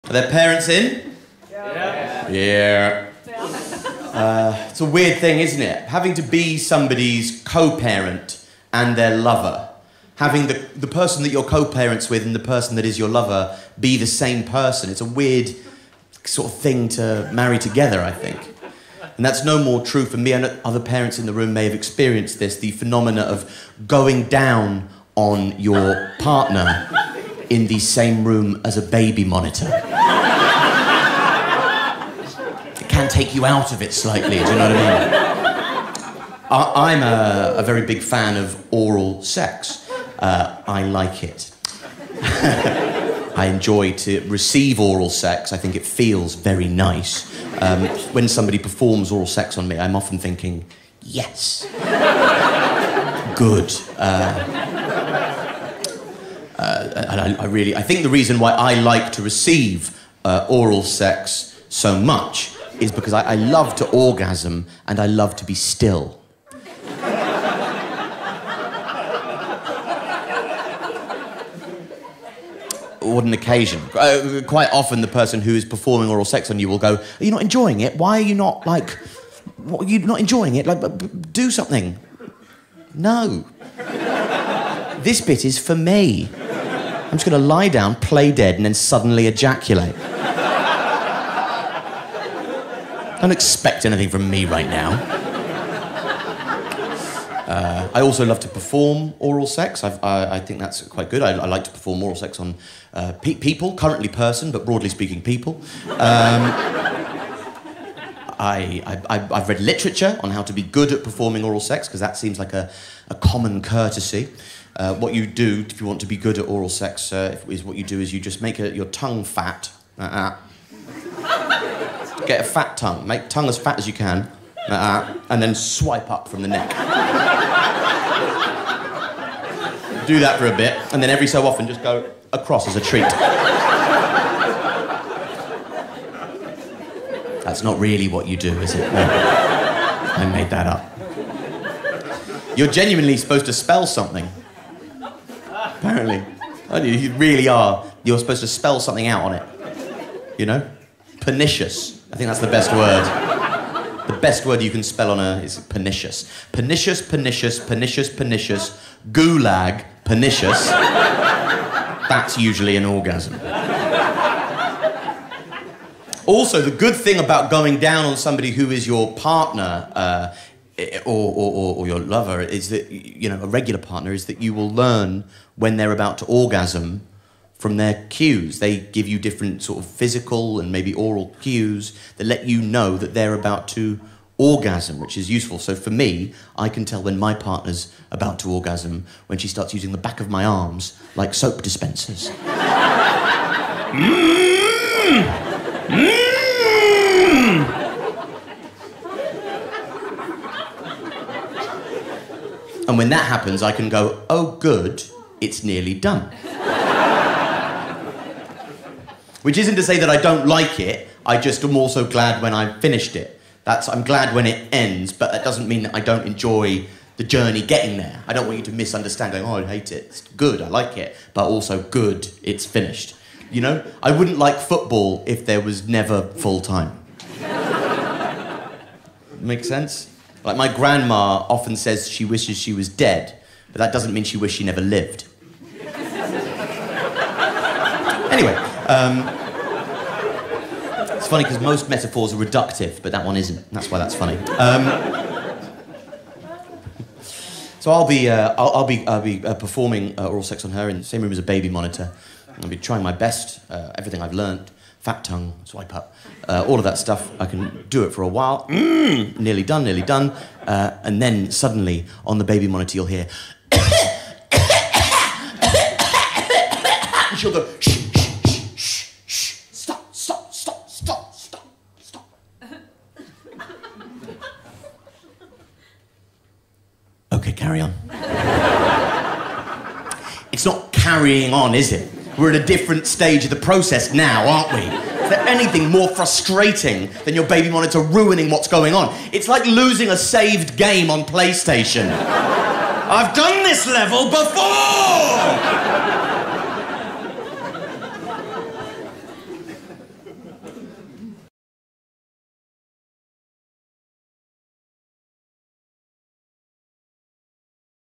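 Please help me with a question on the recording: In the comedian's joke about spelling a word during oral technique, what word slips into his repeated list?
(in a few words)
gulag.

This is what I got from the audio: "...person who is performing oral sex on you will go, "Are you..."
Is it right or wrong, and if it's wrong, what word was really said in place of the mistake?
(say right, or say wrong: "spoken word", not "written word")
right.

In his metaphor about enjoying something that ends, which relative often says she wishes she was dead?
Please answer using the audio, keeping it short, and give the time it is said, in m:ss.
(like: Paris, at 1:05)
grandma, at 3:50.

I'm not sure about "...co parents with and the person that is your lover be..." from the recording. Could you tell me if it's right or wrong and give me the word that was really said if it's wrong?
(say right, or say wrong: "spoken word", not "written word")
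right.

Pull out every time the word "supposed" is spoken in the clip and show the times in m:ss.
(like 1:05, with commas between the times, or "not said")
2:23, 2:28.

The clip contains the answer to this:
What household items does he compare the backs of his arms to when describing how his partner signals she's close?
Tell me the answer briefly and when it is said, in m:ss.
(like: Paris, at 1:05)
soap dispensers, at 3:11.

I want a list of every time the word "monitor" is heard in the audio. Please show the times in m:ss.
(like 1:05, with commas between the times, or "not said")
0:29, 4:11, 4:22, 4:47.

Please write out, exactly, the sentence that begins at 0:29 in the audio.
it can take you out of it slightly, do you know what I mean?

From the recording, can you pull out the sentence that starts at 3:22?
And when that happens, I can go, oh, good, it's nearly done.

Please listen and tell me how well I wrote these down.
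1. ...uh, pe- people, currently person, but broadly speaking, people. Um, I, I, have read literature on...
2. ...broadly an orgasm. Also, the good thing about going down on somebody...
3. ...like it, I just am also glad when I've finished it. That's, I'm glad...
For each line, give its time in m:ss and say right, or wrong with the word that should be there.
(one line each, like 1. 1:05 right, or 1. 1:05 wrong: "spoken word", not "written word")
1. 1:42 right
2. 2:42 wrong: "usually", not "broadly"
3. 3:30 right.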